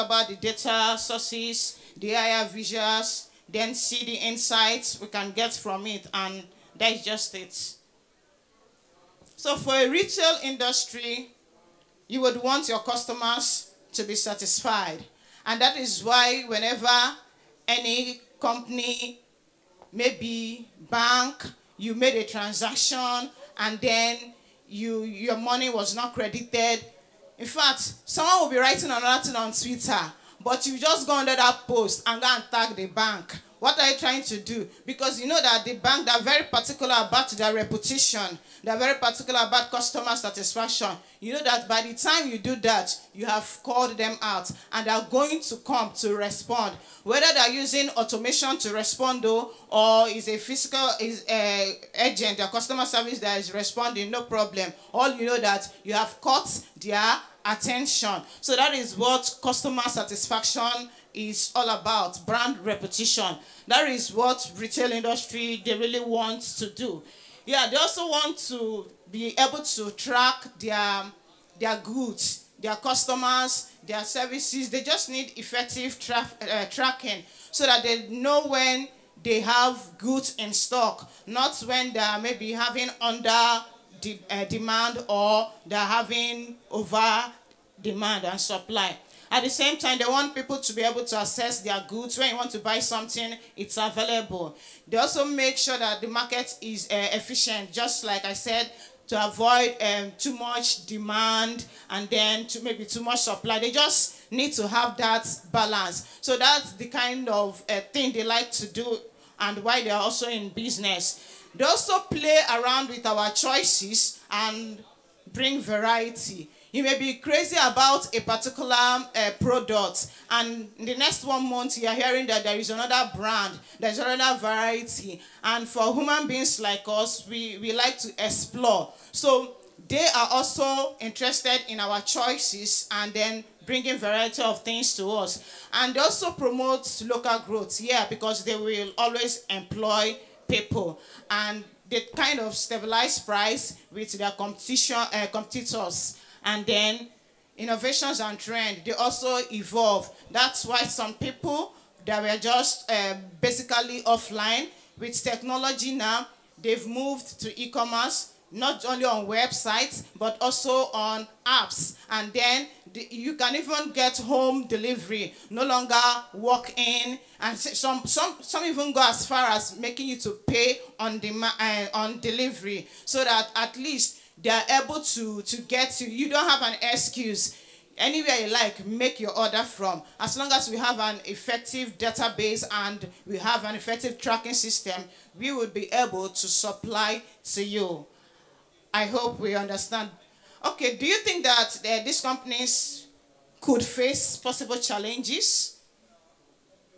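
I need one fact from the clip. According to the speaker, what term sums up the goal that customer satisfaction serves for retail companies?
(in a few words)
brand repetition.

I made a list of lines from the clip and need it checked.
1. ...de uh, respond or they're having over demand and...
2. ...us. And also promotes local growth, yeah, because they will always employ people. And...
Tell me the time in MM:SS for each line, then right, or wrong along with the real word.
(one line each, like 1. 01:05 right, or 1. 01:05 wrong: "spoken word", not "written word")
1. 01:24 wrong: "demand", not "respond"
2. 02:15 right.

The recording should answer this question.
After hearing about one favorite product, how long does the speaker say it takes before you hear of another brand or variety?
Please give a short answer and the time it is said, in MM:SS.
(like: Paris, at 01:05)
one month, at 02:01.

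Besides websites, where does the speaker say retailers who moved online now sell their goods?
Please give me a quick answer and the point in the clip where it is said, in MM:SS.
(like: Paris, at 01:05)
apps, at 02:41.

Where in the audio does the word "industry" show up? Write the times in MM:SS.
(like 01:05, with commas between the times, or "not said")
00:10, 01:04.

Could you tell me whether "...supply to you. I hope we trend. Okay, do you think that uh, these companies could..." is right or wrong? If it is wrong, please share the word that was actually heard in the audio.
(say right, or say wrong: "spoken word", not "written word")
wrong: "understand", not "trend".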